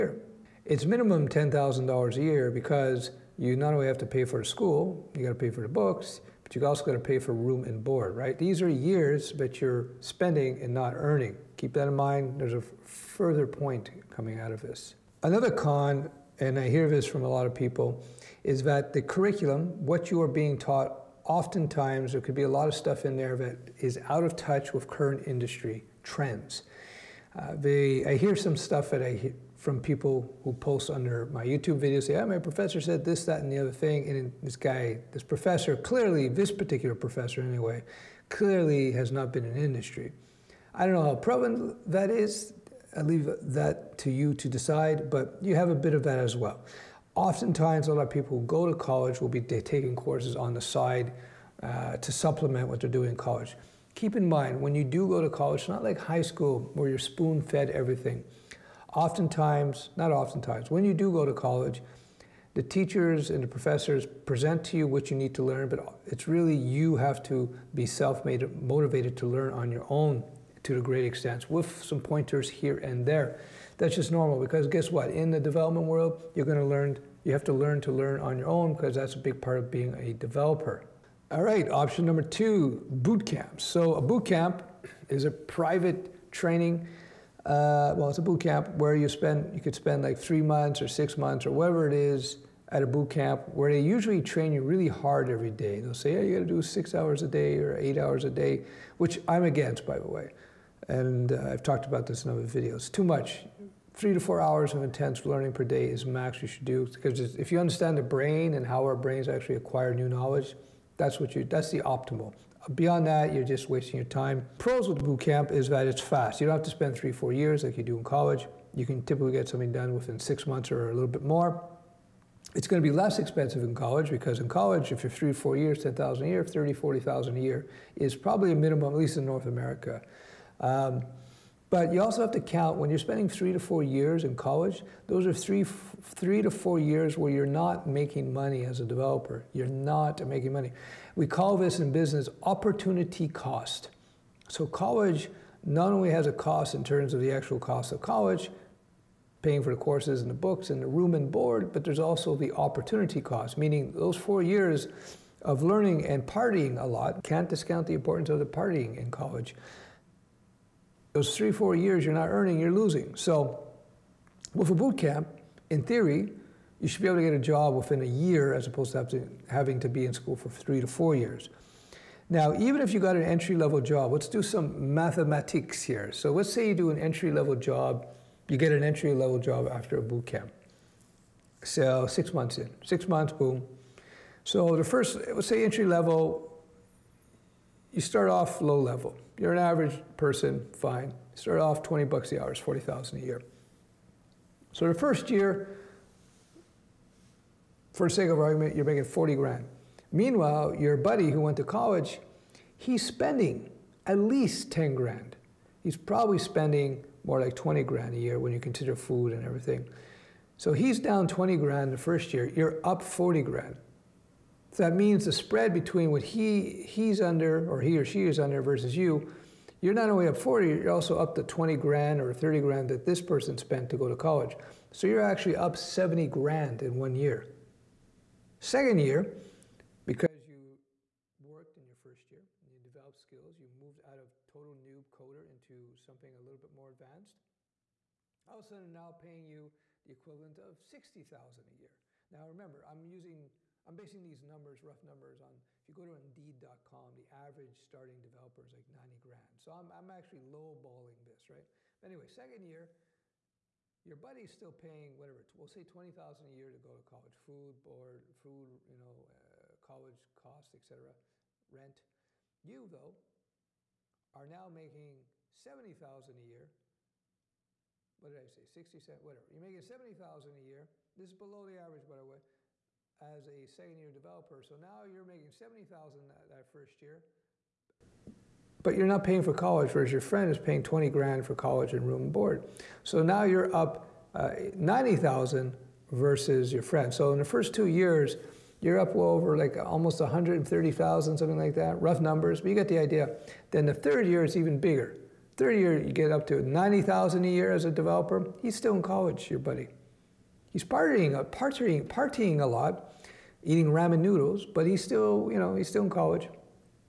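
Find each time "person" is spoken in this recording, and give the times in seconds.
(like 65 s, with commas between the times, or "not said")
190 s, 223 s.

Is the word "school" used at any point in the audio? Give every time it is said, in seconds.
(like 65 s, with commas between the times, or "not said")
4 s, 56 s, 170 s.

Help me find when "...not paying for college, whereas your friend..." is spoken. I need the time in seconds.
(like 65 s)
279 s.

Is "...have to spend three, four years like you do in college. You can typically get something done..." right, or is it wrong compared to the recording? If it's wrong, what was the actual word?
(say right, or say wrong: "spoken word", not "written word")
right.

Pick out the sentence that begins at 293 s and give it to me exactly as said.
Then the third year is even bigger.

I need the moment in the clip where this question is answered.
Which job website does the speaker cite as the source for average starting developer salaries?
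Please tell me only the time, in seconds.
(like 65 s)
246 s.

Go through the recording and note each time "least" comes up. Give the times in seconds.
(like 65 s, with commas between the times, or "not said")
128 s, 204 s.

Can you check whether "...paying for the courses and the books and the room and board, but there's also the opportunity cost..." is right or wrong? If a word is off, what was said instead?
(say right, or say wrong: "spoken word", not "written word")
right.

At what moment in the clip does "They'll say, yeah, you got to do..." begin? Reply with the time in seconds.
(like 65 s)
95 s.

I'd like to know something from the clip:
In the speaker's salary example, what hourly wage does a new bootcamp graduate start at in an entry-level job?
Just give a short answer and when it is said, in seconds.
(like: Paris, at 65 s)
$20, at 191 s.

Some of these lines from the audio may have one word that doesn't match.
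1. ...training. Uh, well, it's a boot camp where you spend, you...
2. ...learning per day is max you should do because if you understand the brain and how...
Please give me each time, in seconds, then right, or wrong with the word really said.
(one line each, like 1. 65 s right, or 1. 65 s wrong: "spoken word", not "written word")
1. 86 s right
2. 105 s right.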